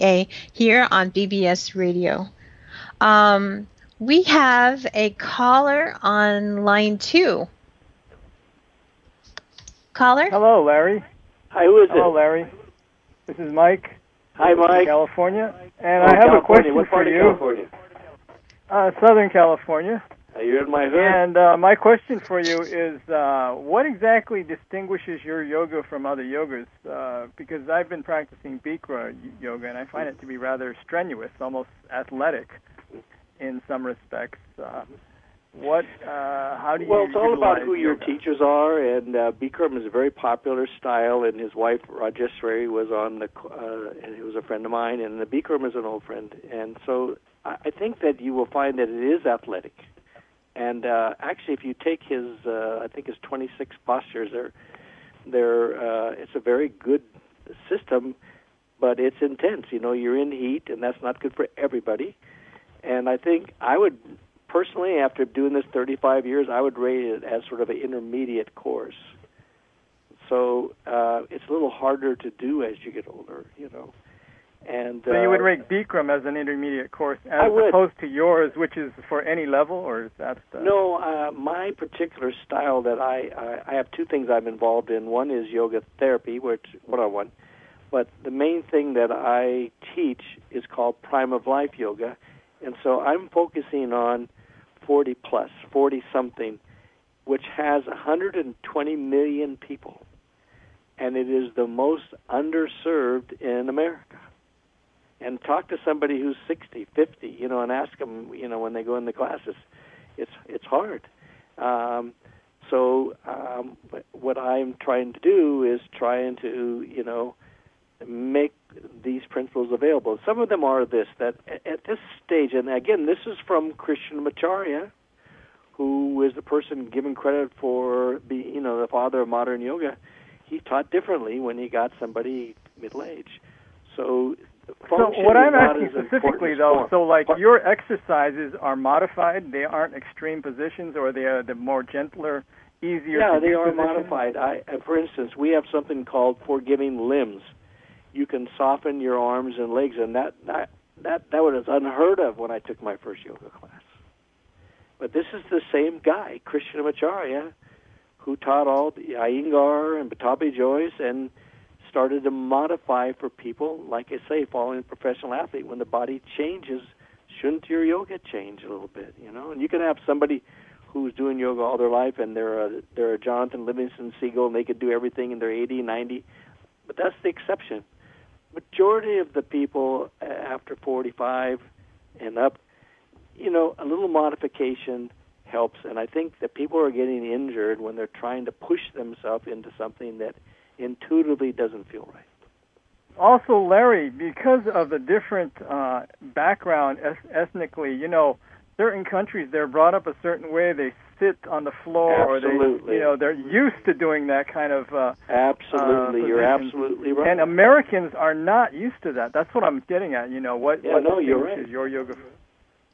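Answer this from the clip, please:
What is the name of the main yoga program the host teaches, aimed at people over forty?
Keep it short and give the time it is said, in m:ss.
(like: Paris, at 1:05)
Prime of Life Yoga, at 1:31.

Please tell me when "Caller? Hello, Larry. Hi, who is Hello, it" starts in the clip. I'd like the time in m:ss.
0:09.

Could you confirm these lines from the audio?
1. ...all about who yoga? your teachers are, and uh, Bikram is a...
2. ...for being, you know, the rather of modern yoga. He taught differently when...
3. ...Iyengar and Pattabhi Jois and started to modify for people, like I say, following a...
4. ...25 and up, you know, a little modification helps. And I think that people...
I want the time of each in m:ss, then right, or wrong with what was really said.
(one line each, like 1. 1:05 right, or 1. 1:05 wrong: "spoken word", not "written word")
1. 0:37 right
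2. 2:07 wrong: "father", not "rather"
3. 2:39 right
4. 3:00 wrong: "45", not "25".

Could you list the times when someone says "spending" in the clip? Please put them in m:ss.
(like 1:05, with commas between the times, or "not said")
not said.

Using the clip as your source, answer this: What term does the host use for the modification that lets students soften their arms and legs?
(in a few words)
forgiving limbs.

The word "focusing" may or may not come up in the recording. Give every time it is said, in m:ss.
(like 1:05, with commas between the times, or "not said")
1:33.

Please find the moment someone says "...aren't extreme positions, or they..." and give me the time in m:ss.
2:19.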